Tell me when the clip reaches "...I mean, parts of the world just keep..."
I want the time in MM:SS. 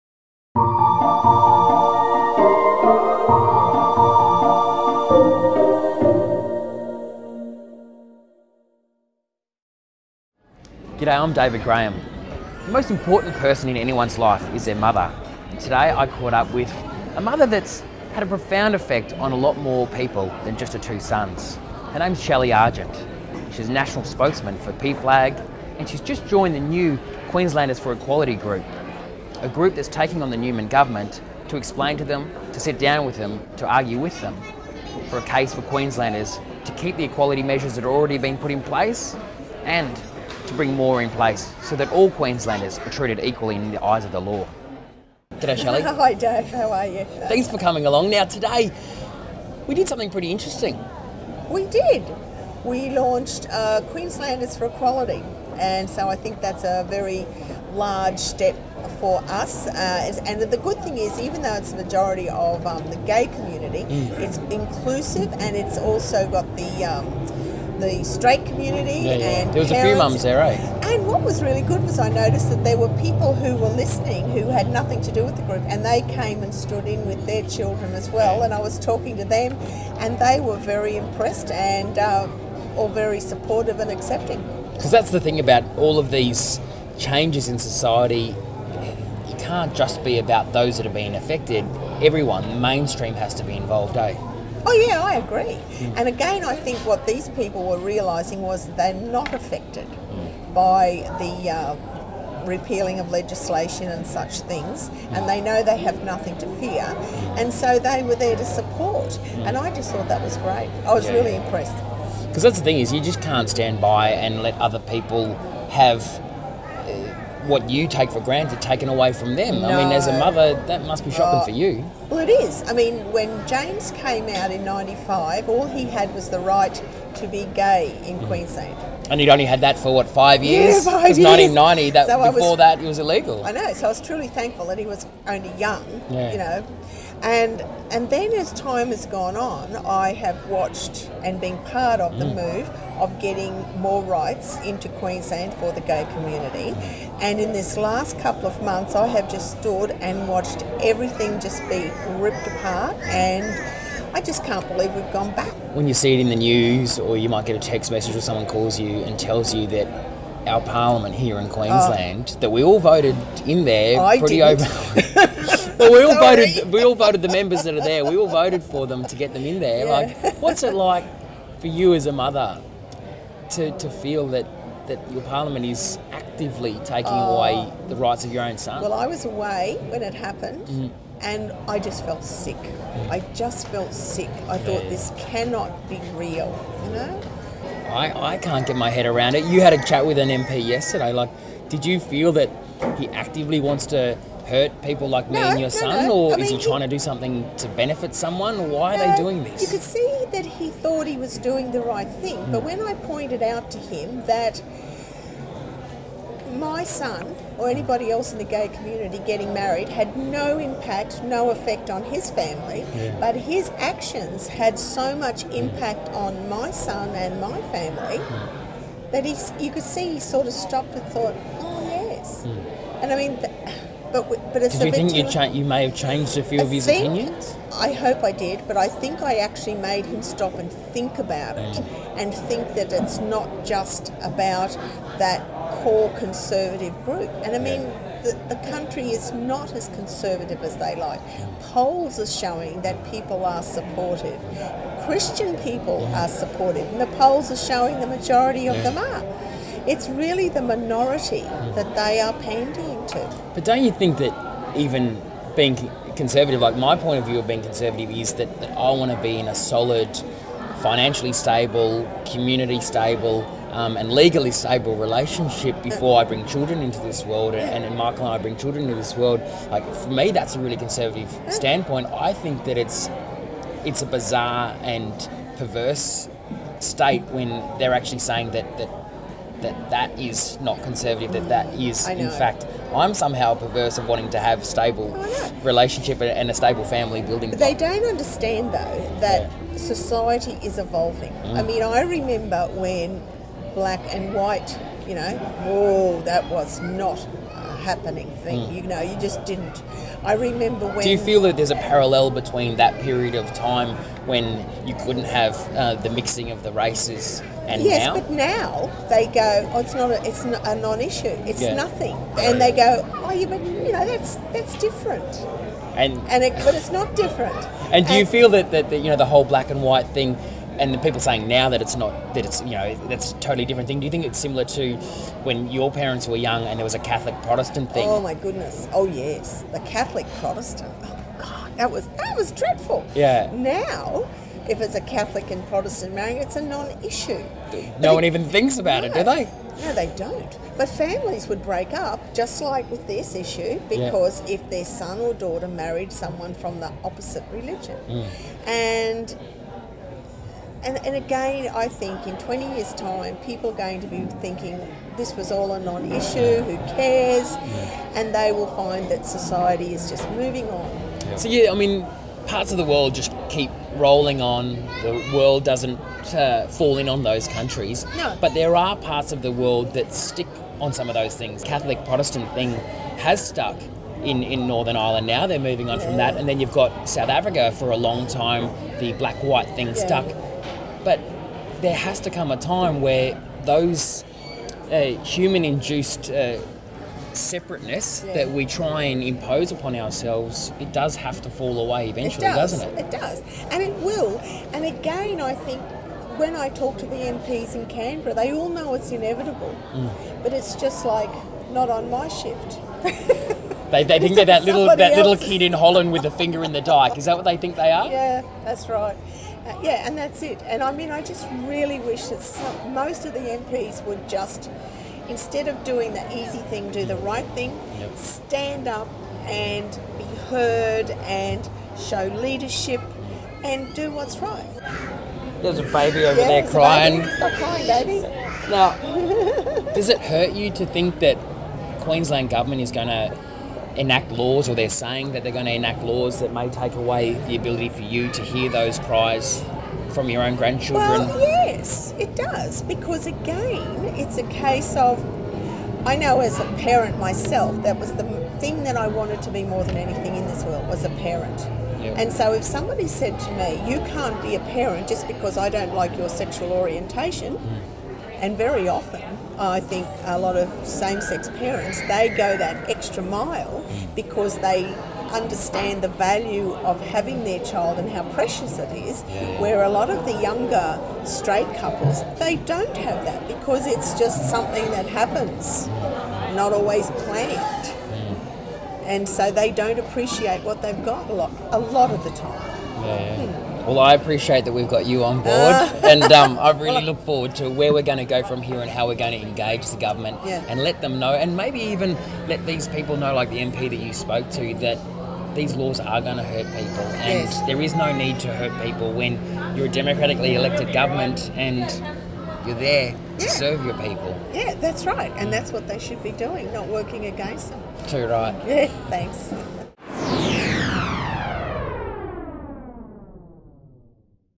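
06:01.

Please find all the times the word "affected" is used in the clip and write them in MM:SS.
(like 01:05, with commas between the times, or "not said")
01:31, 01:39.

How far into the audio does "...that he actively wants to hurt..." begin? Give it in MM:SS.
03:12.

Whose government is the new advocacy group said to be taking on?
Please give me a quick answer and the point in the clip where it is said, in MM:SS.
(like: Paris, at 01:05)
Newman government, at 00:30.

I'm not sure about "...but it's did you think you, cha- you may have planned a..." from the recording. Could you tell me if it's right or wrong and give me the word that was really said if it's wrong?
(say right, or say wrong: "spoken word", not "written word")
wrong: "changed", not "planned".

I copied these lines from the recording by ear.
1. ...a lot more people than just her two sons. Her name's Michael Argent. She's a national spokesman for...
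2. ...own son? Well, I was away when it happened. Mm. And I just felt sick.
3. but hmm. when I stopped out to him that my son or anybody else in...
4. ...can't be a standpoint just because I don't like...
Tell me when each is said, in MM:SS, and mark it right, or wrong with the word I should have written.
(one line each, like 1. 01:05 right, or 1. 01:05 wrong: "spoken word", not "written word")
1. 00:19 wrong: "Shelley", not "Michael"
2. 02:58 right
3. 03:22 wrong: "pointed", not "stopped"
4. 07:34 wrong: "parent", not "standpoint".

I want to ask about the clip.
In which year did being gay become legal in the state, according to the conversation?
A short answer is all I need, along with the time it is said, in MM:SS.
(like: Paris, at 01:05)
1990, at 02:11.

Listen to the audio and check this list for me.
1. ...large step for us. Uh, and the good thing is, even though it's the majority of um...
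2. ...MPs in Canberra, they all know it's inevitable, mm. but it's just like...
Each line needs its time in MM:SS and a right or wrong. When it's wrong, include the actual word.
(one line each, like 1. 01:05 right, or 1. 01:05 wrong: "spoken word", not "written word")
1. 00:57 right
2. 06:37 right.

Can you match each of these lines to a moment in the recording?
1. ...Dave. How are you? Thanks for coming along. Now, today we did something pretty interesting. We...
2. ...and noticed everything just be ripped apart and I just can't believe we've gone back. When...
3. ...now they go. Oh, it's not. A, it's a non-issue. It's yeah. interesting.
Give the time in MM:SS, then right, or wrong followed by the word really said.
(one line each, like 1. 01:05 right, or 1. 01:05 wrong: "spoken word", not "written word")
1. 00:46 right
2. 02:29 wrong: "watched", not "noticed"
3. 05:08 wrong: "nothing", not "interesting".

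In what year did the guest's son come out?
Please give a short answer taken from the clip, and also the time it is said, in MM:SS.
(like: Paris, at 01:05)
1995, at 02:04.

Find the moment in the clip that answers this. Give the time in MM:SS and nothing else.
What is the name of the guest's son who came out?
02:03.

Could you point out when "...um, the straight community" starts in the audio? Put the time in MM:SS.
01:06.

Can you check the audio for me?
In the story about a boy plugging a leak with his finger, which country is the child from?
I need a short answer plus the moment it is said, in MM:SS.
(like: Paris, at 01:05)
Holland, at 06:45.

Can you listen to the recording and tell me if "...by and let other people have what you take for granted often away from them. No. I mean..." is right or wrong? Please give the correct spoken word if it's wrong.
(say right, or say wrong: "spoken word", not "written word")
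wrong: "taken", not "often".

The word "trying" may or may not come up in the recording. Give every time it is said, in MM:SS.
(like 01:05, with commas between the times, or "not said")
03:16.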